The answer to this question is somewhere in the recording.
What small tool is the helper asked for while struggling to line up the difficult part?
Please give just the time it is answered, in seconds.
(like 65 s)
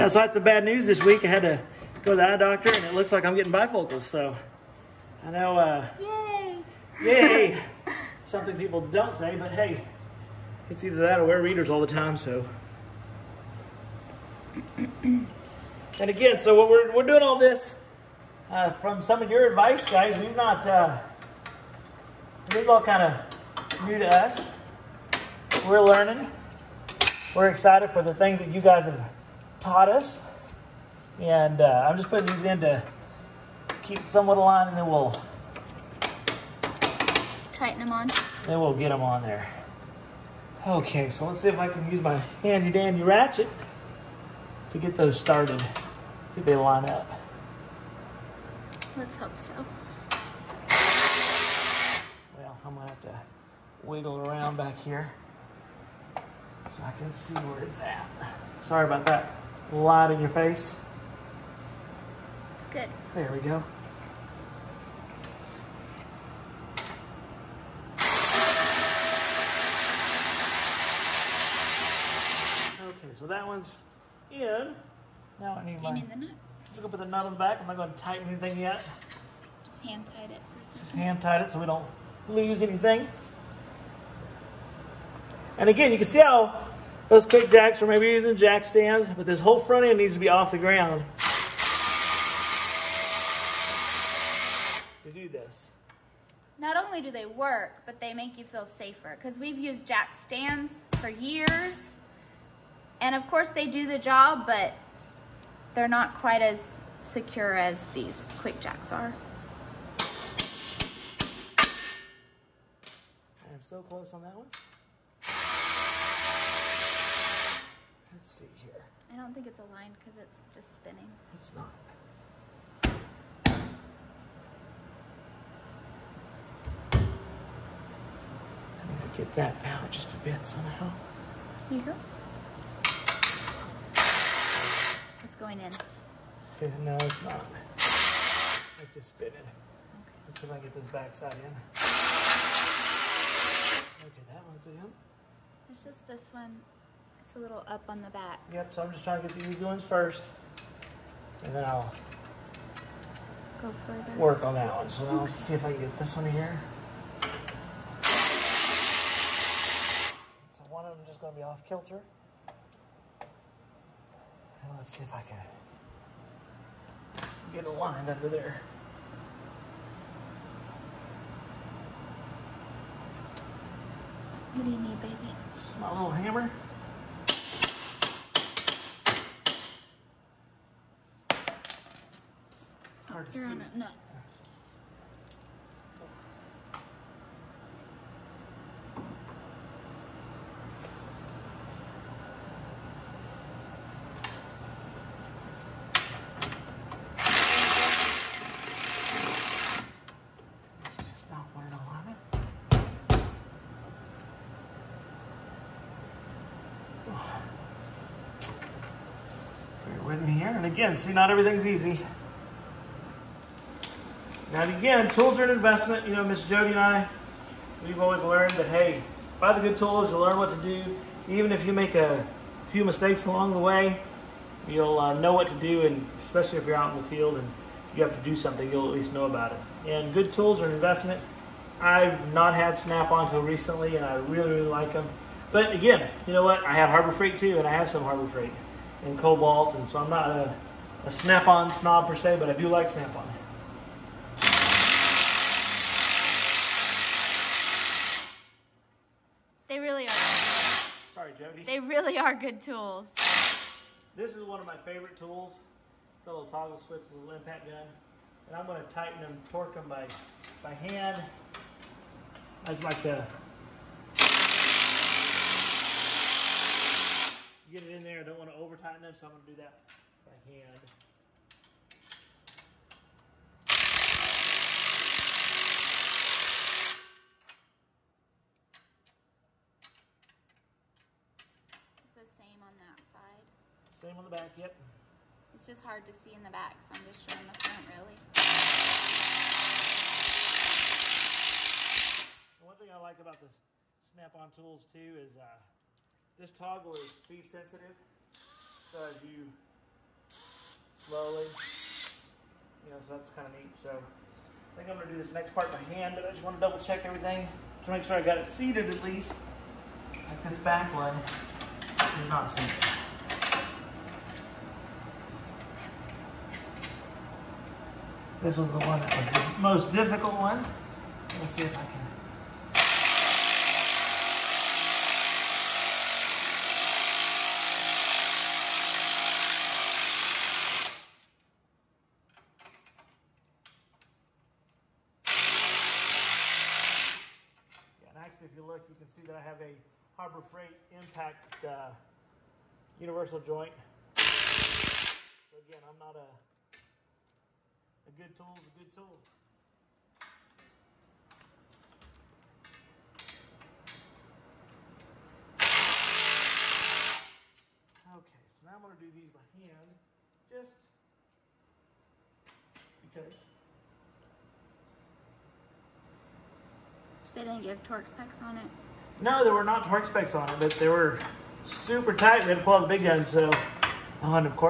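176 s.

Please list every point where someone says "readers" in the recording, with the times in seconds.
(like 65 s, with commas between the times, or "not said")
11 s.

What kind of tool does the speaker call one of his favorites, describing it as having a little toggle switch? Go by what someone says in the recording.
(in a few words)
impact gun.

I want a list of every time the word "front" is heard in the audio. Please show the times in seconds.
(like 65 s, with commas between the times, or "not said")
89 s, 287 s.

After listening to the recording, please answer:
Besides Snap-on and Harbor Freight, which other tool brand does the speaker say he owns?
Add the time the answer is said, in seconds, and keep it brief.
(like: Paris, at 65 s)
Kobalt, at 239 s.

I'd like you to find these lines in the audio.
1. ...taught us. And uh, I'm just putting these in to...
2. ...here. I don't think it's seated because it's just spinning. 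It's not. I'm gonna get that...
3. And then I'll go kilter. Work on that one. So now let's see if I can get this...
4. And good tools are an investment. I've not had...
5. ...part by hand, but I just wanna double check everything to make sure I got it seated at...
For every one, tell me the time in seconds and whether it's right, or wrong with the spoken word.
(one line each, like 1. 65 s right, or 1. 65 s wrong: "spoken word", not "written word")
1. 29 s right
2. 118 s wrong: "aligned", not "seated"
3. 151 s wrong: "further", not "kilter"
4. 229 s right
5. 305 s right.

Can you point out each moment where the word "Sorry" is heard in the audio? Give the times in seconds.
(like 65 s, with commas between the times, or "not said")
58 s, 251 s.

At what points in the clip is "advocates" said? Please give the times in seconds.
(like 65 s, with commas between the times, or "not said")
not said.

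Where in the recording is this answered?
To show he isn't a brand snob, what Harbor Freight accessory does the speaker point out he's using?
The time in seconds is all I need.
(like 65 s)
343 s.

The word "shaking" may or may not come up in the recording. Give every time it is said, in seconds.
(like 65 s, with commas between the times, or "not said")
not said.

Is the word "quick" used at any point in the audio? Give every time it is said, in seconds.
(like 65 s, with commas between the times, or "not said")
87 s, 108 s.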